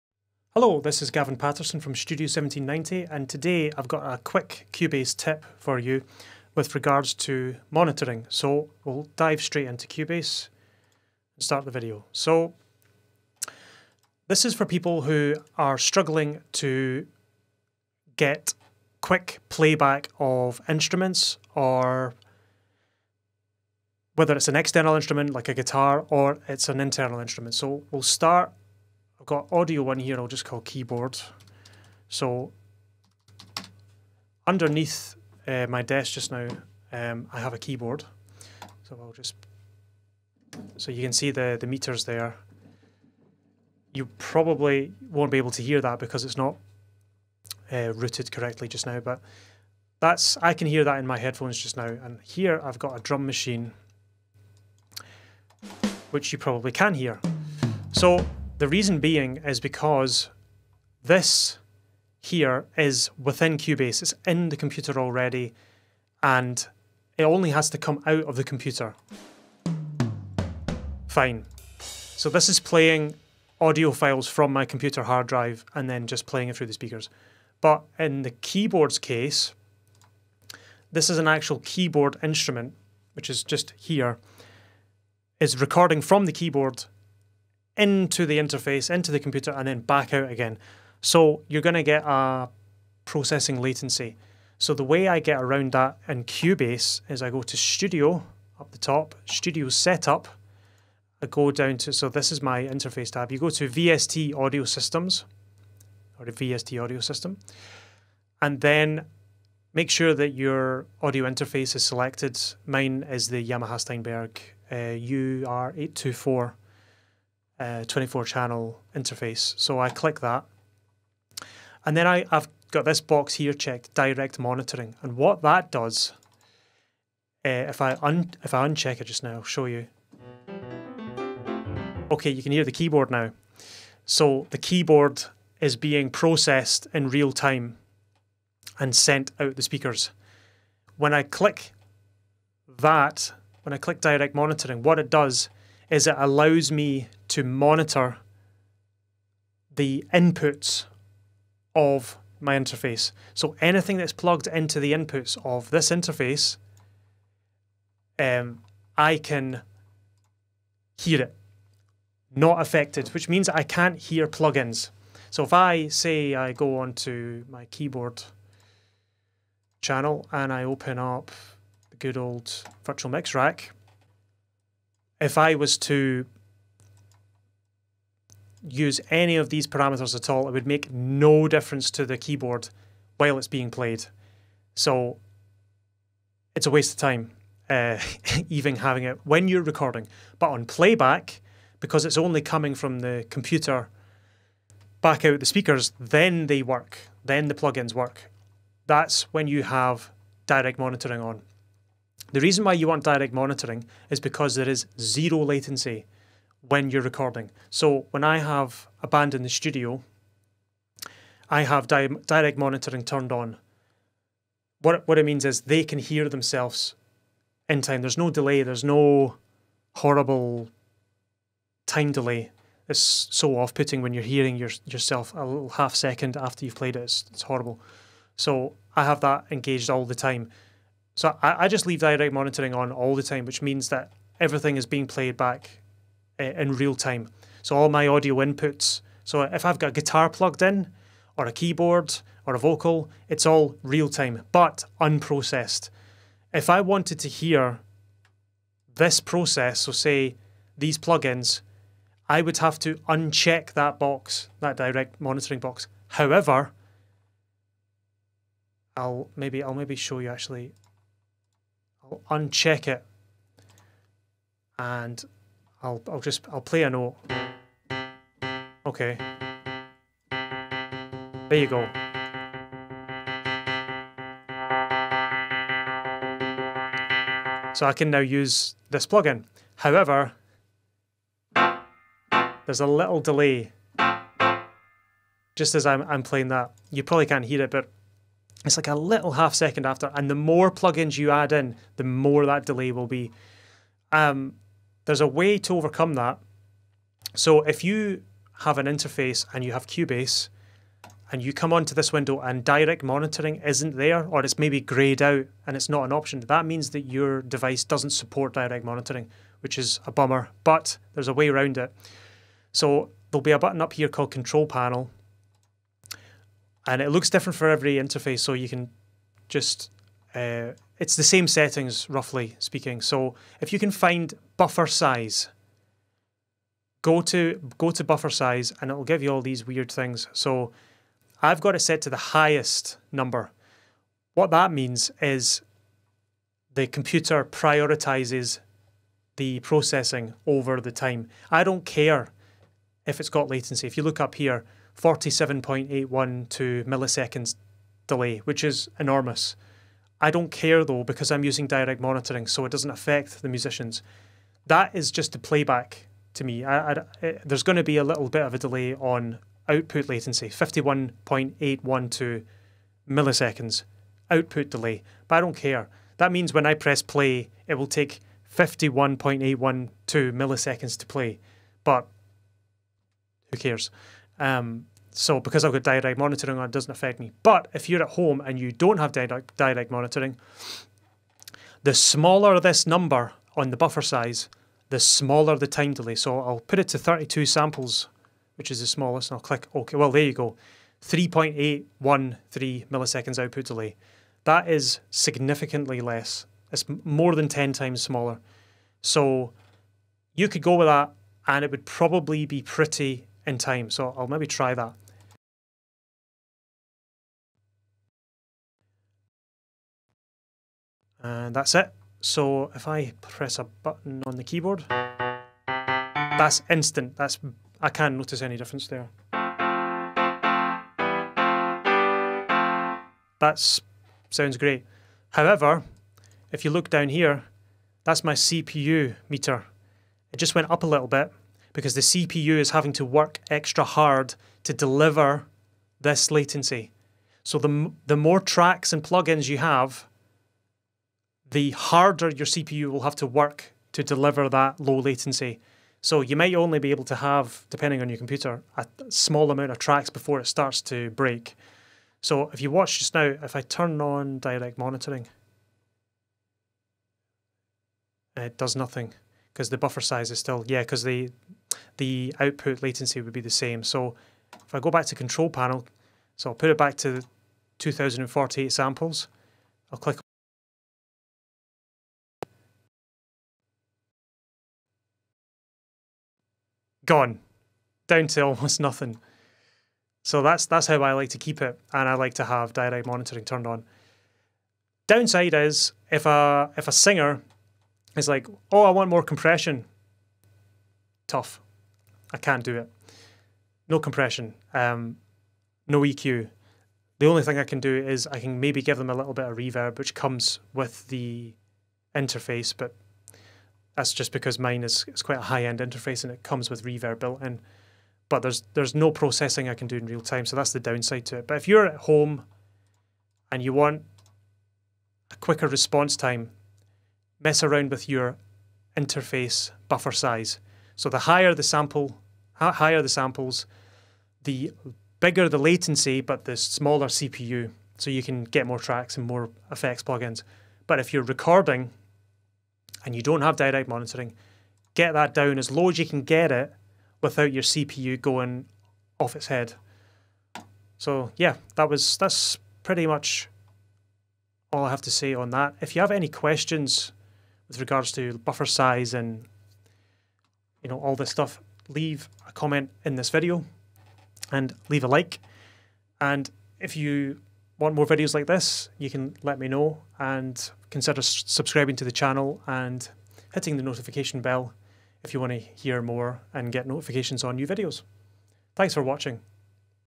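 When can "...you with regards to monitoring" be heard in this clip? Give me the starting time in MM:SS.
00:05.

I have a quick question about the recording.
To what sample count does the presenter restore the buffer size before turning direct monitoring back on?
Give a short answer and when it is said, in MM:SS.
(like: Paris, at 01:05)
2048 samples, at 07:47.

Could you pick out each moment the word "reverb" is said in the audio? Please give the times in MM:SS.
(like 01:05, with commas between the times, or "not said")
08:19, 08:26.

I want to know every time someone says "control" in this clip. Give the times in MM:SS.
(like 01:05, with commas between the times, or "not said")
05:14, 07:45.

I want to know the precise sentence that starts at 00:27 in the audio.
So we'll start I've got audio one here I'll just call keyboard.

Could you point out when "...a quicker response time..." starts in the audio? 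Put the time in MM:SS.
08:35.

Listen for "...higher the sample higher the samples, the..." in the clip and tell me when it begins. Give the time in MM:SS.
08:41.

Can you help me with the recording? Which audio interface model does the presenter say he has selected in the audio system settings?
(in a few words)
UR824.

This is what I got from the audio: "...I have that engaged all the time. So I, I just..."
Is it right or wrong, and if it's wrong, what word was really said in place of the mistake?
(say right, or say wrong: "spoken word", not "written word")
right.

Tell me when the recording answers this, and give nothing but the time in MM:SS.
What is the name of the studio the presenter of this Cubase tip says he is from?
00:01.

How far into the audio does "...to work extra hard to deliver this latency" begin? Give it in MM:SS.
07:12.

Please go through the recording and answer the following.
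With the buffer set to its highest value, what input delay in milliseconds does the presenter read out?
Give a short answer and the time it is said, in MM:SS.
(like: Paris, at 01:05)
47.812 milliseconds, at 05:44.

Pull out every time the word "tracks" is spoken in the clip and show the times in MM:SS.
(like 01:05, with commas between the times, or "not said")
07:18, 07:29, 08:48.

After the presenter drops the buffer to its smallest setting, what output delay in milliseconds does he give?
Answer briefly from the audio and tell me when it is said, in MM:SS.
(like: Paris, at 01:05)
3.813 milliseconds, at 06:31.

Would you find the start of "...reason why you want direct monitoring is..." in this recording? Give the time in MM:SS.
03:22.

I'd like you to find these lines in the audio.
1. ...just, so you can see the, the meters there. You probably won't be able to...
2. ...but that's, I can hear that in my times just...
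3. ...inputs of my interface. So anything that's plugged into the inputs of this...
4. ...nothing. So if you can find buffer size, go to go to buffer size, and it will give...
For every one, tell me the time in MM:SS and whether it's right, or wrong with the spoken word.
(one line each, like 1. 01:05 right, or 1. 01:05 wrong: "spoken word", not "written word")
1. 00:39 right
2. 00:49 wrong: "headphones", not "times"
3. 02:30 right
4. 05:22 wrong: "speaking", not "nothing".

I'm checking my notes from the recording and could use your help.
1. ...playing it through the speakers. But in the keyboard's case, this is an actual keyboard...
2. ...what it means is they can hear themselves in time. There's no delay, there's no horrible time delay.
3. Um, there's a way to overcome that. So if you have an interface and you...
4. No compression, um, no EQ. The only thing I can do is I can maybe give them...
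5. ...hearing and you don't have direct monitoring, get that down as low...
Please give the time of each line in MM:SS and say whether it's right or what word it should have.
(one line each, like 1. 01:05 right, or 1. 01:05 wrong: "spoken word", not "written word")
1. 01:16 right
2. 03:35 right
3. 04:54 right
4. 08:13 right
5. 08:51 wrong: "recording", not "hearing".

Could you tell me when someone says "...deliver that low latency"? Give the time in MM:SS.
07:24.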